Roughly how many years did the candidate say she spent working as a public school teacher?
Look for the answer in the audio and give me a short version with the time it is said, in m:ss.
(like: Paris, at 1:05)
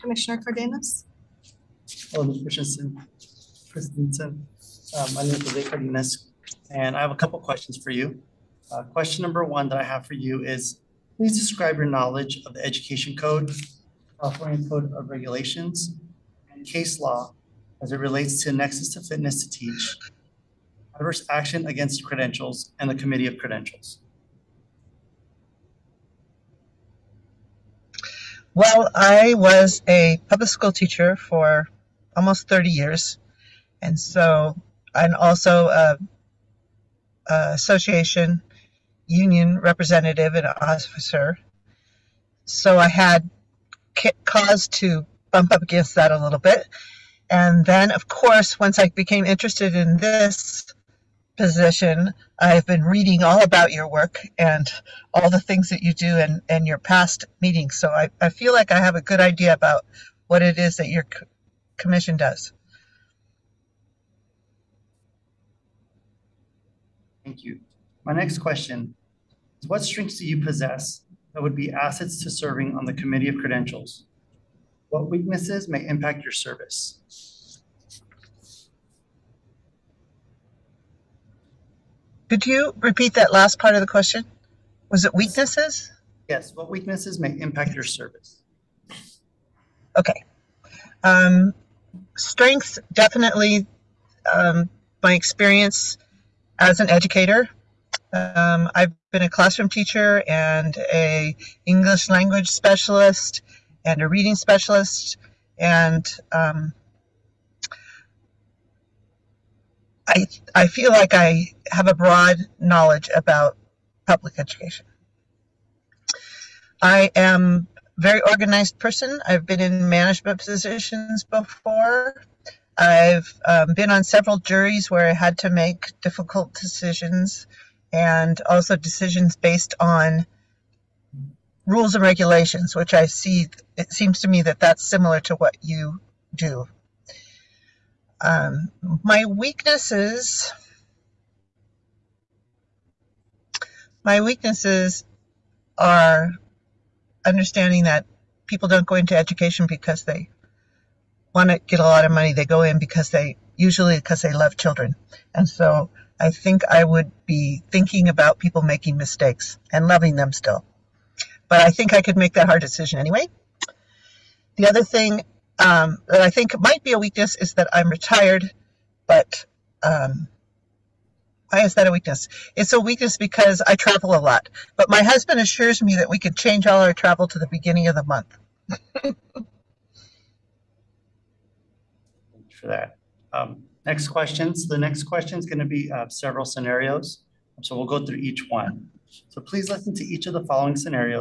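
almost 30 years, at 0:32.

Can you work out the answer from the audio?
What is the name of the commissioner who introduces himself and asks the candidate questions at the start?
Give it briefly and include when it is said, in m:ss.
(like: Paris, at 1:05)
Jose Cardenas, at 0:05.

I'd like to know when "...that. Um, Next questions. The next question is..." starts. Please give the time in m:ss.
3:02.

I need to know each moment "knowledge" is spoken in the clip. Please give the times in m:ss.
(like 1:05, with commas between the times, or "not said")
0:11, 1:52.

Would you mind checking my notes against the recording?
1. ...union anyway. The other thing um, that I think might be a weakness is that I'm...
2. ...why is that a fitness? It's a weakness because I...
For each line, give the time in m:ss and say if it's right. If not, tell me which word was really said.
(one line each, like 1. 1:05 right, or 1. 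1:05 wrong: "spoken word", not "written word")
1. 2:42 wrong: "decision", not "union"
2. 2:51 wrong: "weakness", not "fitness".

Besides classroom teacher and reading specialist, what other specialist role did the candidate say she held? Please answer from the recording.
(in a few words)
English language specialist.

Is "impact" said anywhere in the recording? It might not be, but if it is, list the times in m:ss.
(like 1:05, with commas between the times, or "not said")
1:15, 1:27.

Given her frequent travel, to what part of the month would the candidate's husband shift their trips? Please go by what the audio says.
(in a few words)
the beginning.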